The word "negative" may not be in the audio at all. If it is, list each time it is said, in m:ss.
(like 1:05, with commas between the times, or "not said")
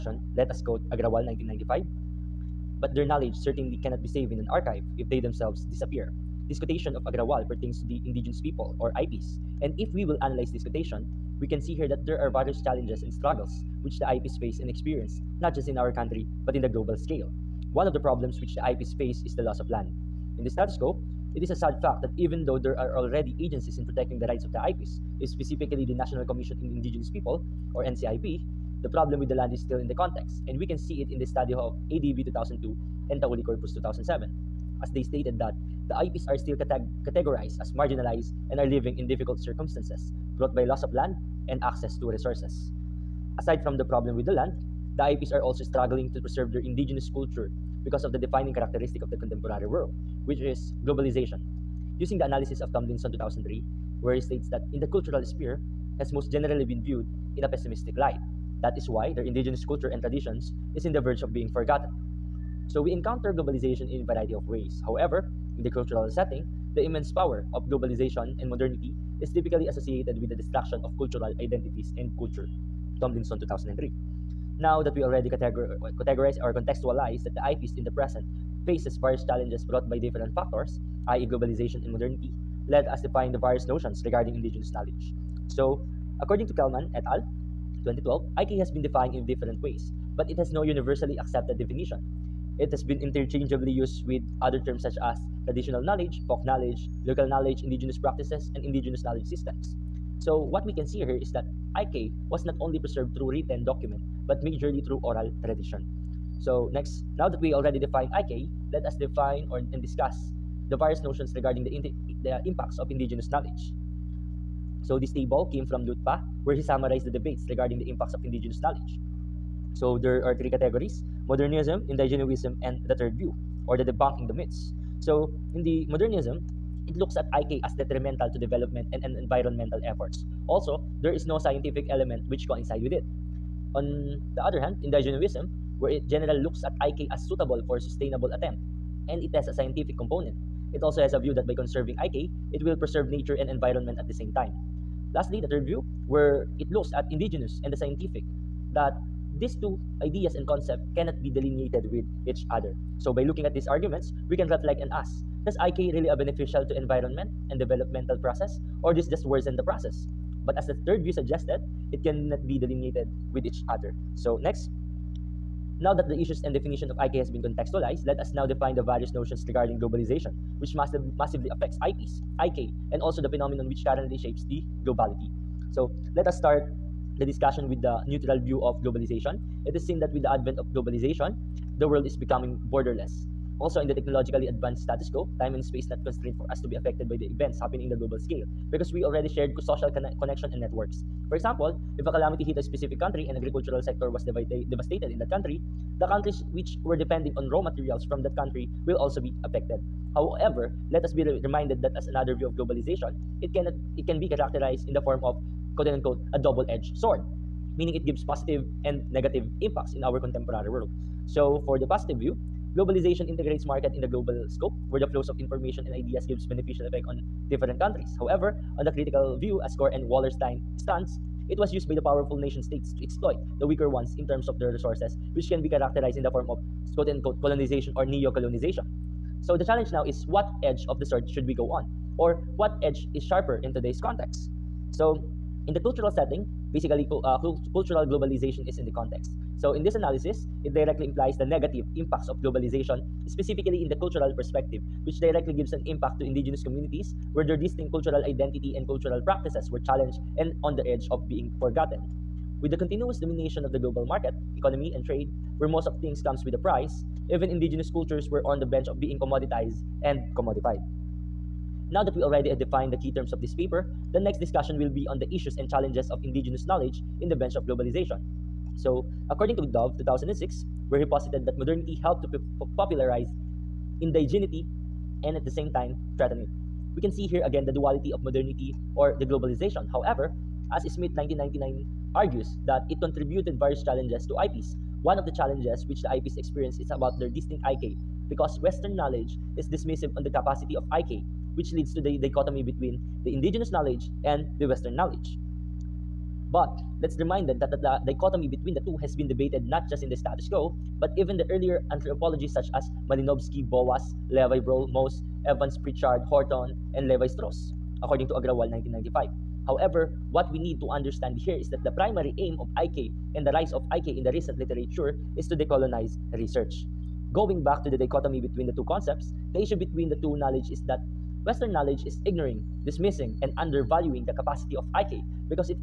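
3:29, 4:01.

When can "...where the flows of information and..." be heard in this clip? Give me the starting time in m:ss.
3:34.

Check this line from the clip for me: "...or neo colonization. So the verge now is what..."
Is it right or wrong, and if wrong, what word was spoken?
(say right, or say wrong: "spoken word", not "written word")
wrong: "challenge", not "verge".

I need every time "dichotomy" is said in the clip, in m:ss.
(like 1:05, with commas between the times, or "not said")
4:52, 4:58, 5:17.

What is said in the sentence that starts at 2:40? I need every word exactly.
But as the third view suggested, it cannot be delineated with each other.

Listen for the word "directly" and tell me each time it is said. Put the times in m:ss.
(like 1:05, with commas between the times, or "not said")
4:00, 4:05.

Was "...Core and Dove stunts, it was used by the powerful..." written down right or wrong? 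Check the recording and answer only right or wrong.
wrong.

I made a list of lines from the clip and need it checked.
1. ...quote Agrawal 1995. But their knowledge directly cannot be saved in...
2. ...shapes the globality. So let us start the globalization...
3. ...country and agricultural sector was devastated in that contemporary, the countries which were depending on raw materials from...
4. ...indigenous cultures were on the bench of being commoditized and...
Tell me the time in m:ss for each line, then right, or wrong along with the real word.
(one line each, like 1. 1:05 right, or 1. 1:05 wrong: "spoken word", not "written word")
1. 0:00 wrong: "certainly", not "directly"
2. 2:54 wrong: "discussion", not "globalization"
3. 3:12 wrong: "country", not "contemporary"
4. 4:17 right.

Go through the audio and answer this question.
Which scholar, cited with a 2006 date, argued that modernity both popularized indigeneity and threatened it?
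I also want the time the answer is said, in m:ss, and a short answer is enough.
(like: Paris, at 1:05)
Dove, at 4:29.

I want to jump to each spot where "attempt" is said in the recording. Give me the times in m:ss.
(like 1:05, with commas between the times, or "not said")
2:18.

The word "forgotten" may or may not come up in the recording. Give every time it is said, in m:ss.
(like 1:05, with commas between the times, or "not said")
1:01, 4:11.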